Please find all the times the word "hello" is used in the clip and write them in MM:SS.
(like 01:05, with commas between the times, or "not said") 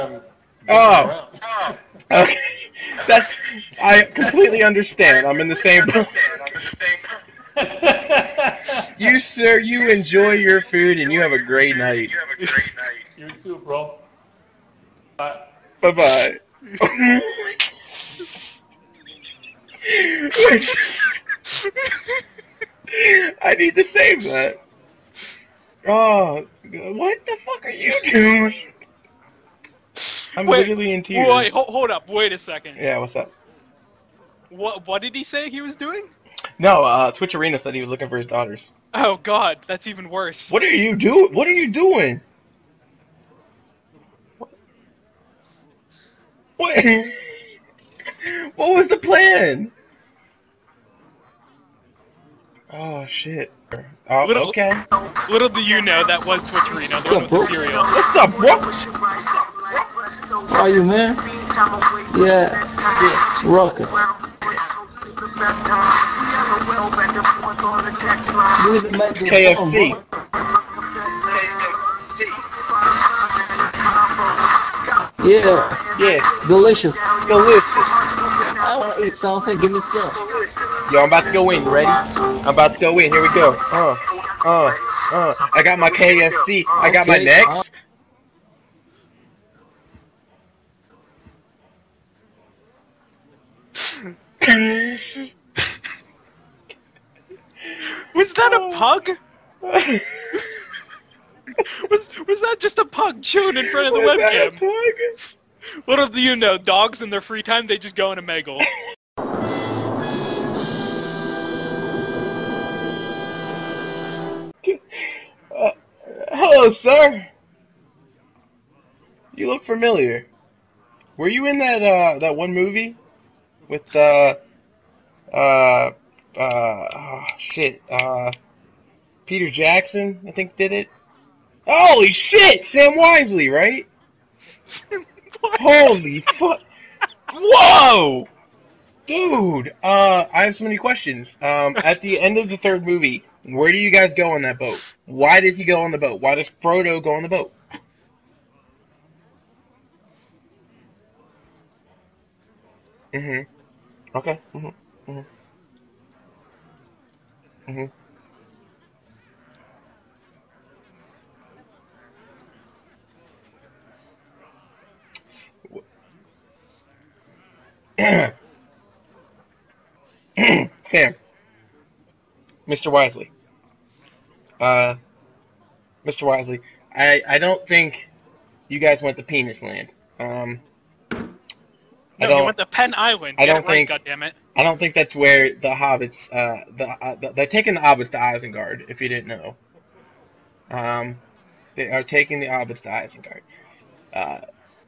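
01:56.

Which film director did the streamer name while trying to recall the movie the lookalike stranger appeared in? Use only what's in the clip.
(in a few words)
Peter Jackson.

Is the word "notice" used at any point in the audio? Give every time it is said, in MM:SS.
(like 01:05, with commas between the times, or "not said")
not said.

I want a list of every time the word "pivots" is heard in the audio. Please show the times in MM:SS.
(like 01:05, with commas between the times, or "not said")
not said.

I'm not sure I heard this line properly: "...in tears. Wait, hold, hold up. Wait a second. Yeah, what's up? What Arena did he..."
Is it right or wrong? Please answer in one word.
wrong.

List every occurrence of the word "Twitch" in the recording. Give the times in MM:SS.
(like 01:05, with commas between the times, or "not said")
00:37, 00:56.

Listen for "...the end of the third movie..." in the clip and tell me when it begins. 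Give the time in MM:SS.
02:22.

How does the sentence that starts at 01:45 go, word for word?
What do you know, dogs in their free time they just go in Omegle.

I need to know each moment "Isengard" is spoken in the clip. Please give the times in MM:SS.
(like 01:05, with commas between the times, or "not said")
03:08, 03:12.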